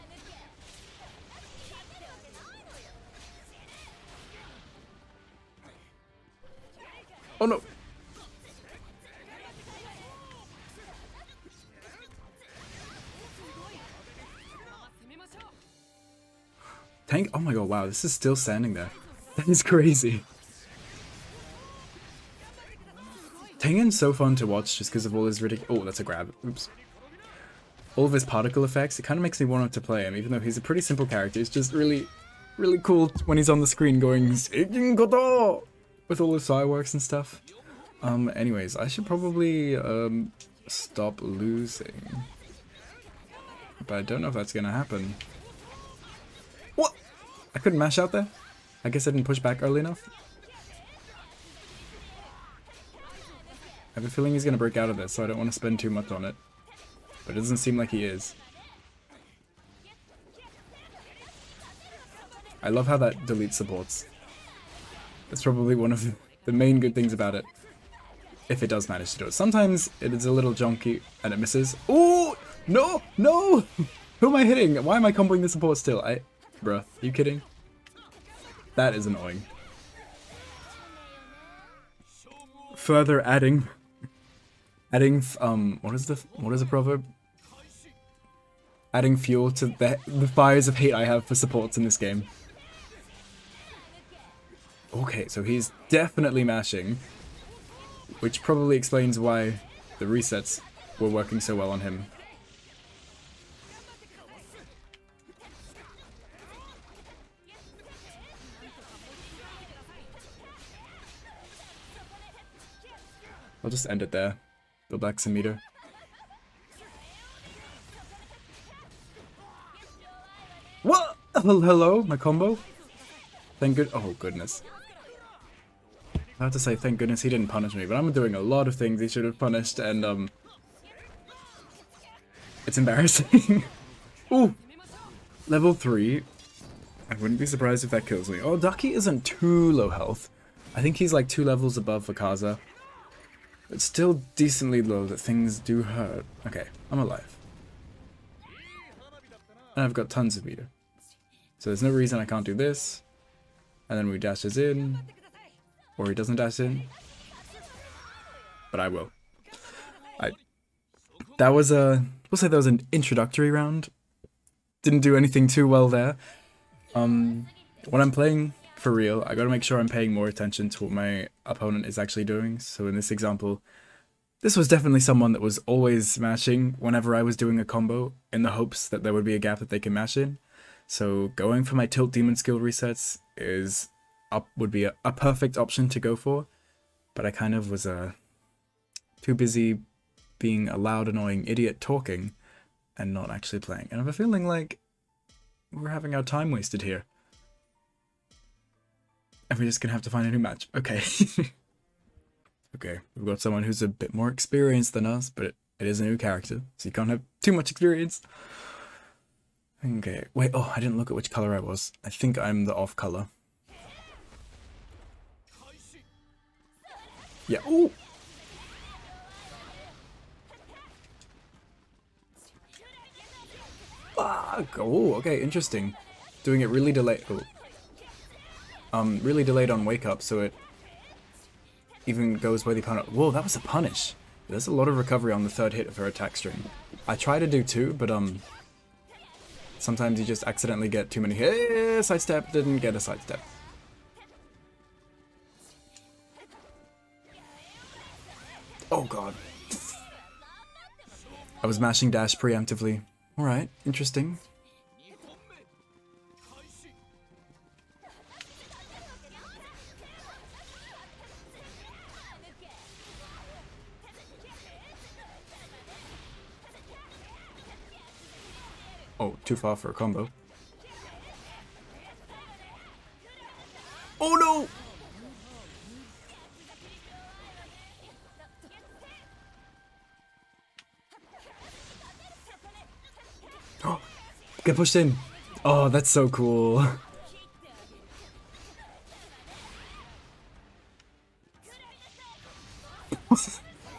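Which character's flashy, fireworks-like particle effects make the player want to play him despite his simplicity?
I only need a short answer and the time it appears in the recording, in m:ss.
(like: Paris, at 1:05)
Tengen, at 0:23.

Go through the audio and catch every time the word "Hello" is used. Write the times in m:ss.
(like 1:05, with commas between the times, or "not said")
2:01.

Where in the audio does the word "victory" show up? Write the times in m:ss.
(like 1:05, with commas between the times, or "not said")
not said.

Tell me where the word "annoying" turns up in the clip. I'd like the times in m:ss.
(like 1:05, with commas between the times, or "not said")
1:19, 3:11.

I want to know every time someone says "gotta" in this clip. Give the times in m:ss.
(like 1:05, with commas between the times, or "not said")
2:49.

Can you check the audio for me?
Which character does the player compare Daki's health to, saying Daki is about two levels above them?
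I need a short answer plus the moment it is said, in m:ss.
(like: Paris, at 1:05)
Akaza, at 2:22.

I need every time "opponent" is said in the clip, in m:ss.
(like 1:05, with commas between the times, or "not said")
2:51, 3:52.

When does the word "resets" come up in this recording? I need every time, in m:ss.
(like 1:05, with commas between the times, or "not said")
1:40, 3:02.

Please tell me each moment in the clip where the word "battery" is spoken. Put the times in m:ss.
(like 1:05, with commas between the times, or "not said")
not said.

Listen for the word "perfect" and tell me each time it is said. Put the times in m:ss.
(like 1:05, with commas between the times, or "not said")
3:05.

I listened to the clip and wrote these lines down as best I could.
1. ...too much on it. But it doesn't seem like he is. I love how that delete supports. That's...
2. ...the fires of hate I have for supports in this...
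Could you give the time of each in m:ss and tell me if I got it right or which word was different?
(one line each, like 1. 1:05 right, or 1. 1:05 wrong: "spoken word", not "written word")
1. 0:55 right
2. 1:30 right.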